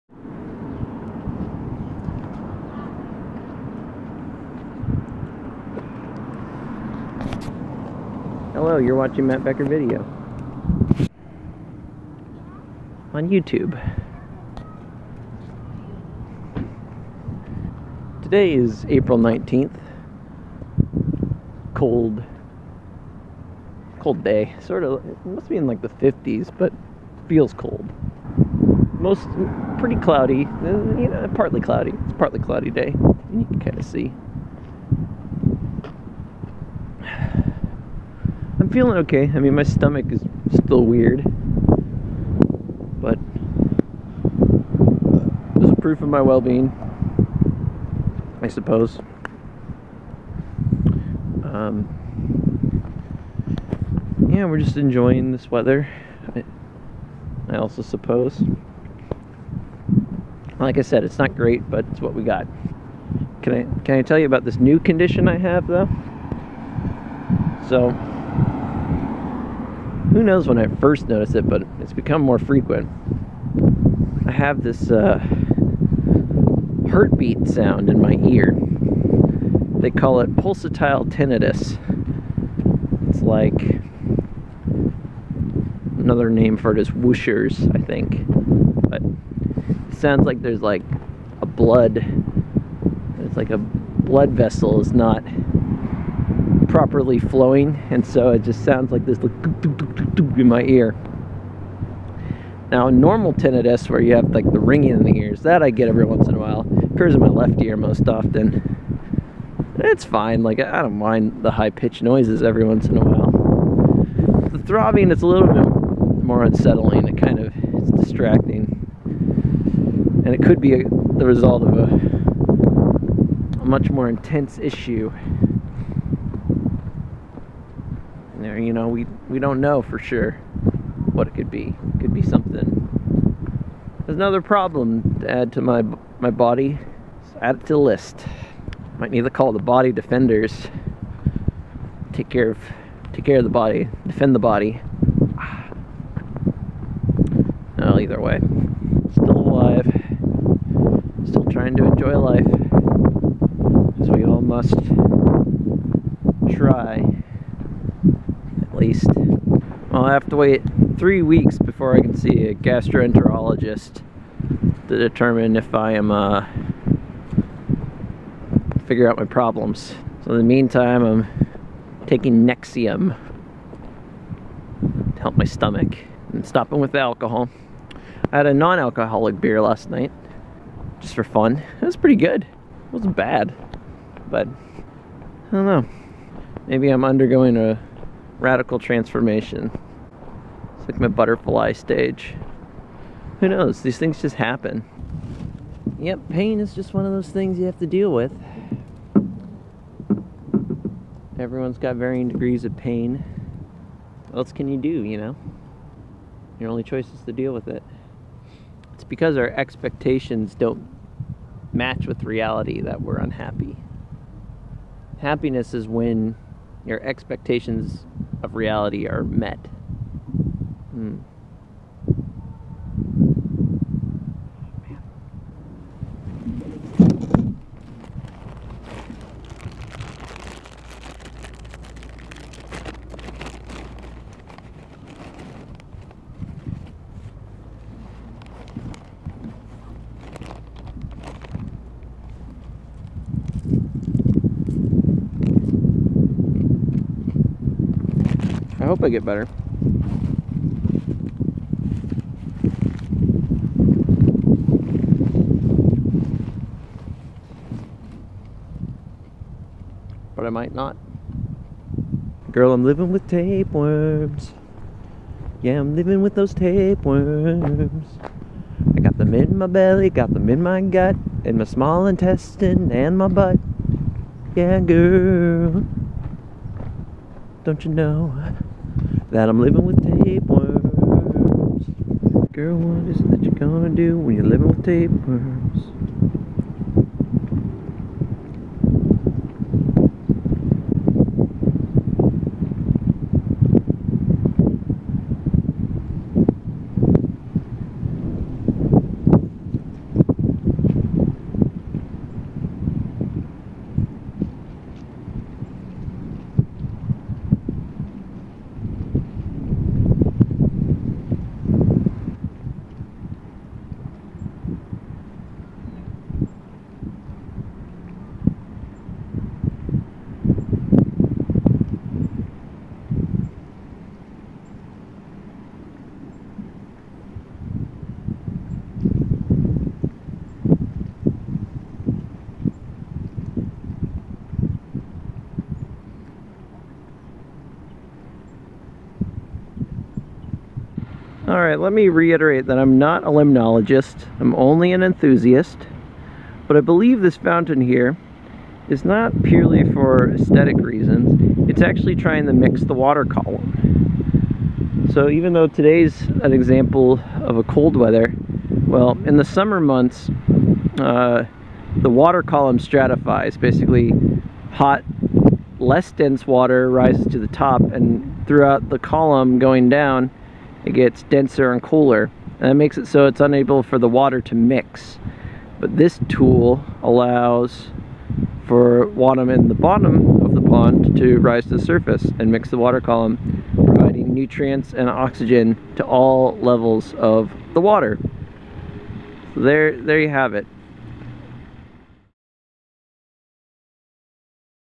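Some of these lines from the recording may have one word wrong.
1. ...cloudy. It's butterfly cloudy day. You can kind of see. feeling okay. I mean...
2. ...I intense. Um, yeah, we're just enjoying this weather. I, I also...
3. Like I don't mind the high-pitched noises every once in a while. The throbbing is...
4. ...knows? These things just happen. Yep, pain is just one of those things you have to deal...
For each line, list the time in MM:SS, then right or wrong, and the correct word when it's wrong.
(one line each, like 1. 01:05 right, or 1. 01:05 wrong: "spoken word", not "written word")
1. 00:31 wrong: "partly", not "butterfly"
2. 00:48 wrong: "suppose", not "intense"
3. 01:50 right
4. 03:13 right.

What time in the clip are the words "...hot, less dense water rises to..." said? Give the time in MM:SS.
06:04.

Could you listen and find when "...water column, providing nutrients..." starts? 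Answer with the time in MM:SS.
06:22.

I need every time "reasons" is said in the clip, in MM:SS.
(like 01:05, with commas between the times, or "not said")
05:50.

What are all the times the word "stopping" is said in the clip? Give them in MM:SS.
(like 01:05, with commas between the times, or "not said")
02:56.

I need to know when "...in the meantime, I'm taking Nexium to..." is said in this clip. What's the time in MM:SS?
02:50.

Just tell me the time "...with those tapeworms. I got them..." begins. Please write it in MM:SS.
04:26.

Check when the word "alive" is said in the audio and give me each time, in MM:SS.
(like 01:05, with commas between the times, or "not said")
02:29.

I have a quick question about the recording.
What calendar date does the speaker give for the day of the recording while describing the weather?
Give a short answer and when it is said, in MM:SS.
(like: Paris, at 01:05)
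April 19th, at 00:18.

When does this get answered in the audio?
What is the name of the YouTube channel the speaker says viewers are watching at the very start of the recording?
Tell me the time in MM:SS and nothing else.
00:09.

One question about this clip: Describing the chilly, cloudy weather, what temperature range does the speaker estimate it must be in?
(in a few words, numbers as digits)
the 50s.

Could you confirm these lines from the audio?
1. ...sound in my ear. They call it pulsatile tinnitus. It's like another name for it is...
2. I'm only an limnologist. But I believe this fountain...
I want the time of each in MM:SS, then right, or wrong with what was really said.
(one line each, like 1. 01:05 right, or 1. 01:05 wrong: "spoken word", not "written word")
1. 01:17 right
2. 05:44 wrong: "enthusiast", not "limnologist".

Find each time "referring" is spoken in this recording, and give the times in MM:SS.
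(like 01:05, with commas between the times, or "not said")
not said.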